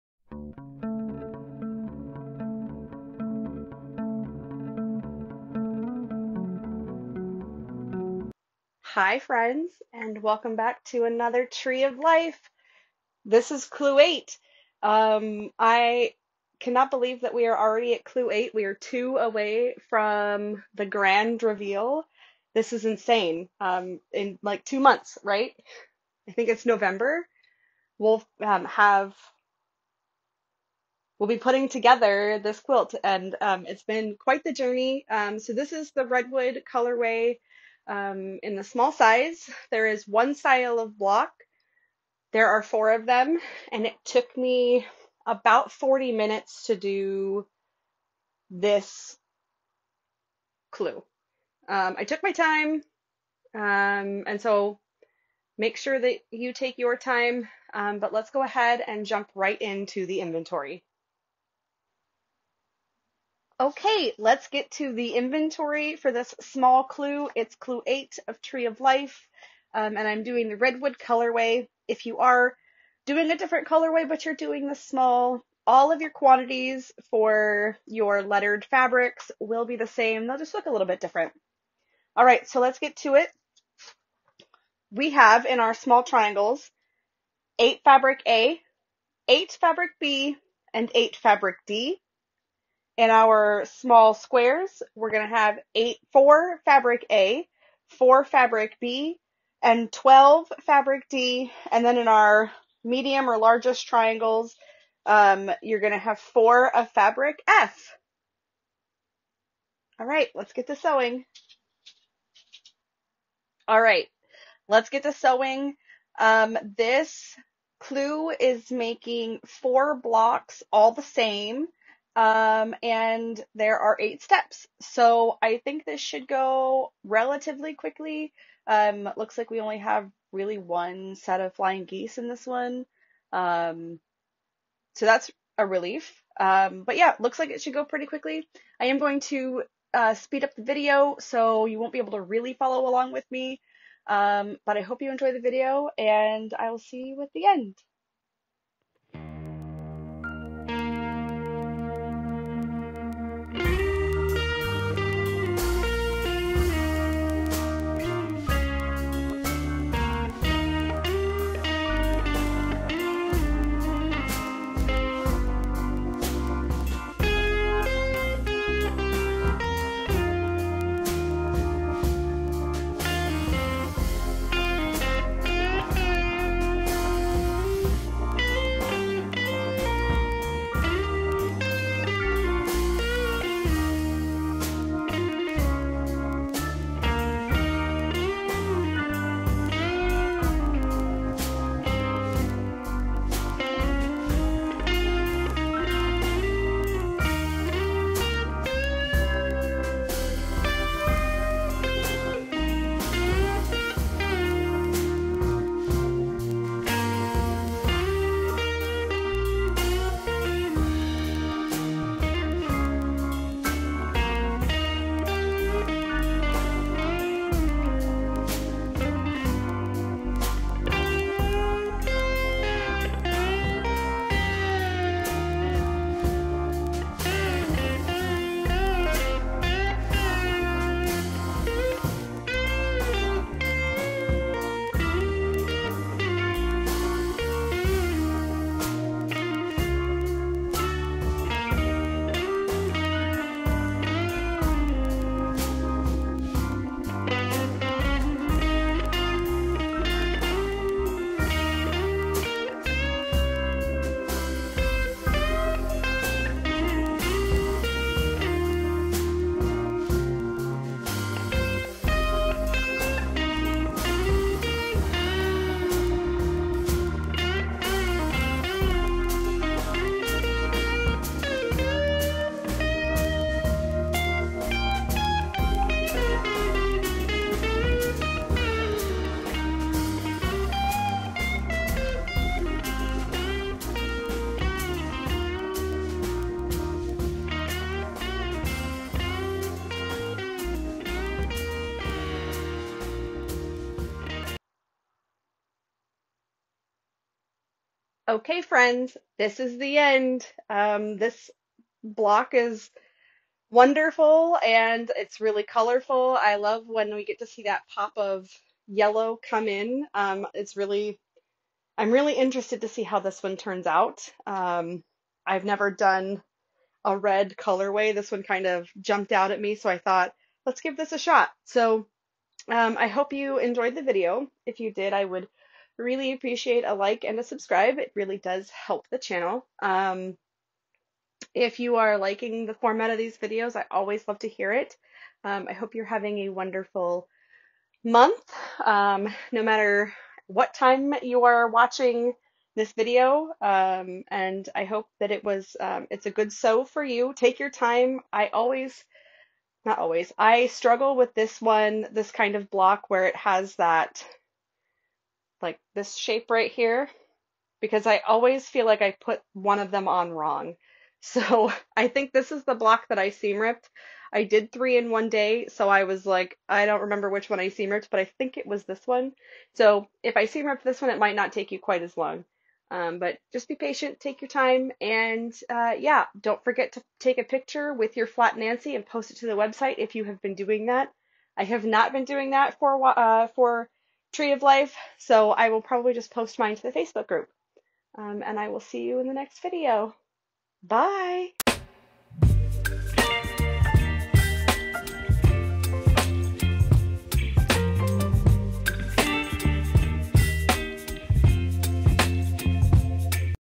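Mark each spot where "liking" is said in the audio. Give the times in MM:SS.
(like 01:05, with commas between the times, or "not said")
05:32.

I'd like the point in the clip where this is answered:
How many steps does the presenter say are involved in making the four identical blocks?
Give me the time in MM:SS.
02:03.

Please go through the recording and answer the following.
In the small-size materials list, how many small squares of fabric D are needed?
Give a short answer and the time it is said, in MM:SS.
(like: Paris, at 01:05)
12, at 01:39.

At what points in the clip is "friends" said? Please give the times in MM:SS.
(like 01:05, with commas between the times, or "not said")
00:09, 04:58.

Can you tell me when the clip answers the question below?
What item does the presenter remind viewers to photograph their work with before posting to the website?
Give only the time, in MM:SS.
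06:18.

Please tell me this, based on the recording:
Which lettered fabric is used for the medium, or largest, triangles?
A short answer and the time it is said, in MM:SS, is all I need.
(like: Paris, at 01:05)
Fabric F, at 01:46.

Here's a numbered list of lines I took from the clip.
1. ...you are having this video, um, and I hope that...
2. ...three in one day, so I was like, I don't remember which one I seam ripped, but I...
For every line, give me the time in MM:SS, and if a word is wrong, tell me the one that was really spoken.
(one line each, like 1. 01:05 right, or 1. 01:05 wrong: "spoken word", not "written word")
1. 05:41 wrong: "watching", not "having"
2. 06:04 right.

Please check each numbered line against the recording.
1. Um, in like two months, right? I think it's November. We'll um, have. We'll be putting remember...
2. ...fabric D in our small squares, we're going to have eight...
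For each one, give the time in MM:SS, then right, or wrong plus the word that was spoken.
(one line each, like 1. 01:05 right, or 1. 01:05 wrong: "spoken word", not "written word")
1. 00:23 wrong: "together", not "remember"
2. 01:31 right.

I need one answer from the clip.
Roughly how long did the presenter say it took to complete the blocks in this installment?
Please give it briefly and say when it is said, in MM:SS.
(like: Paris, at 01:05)
40 minutes, at 00:45.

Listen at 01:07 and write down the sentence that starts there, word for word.
It's clue eight of Tree of Life, um, and I'm doing the redwood colorway.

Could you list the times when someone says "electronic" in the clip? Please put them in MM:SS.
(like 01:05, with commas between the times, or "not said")
not said.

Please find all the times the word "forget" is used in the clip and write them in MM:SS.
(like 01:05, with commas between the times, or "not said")
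06:16.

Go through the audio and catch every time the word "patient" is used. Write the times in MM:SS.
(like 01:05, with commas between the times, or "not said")
06:13.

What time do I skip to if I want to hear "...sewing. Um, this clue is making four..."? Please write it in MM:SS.
01:55.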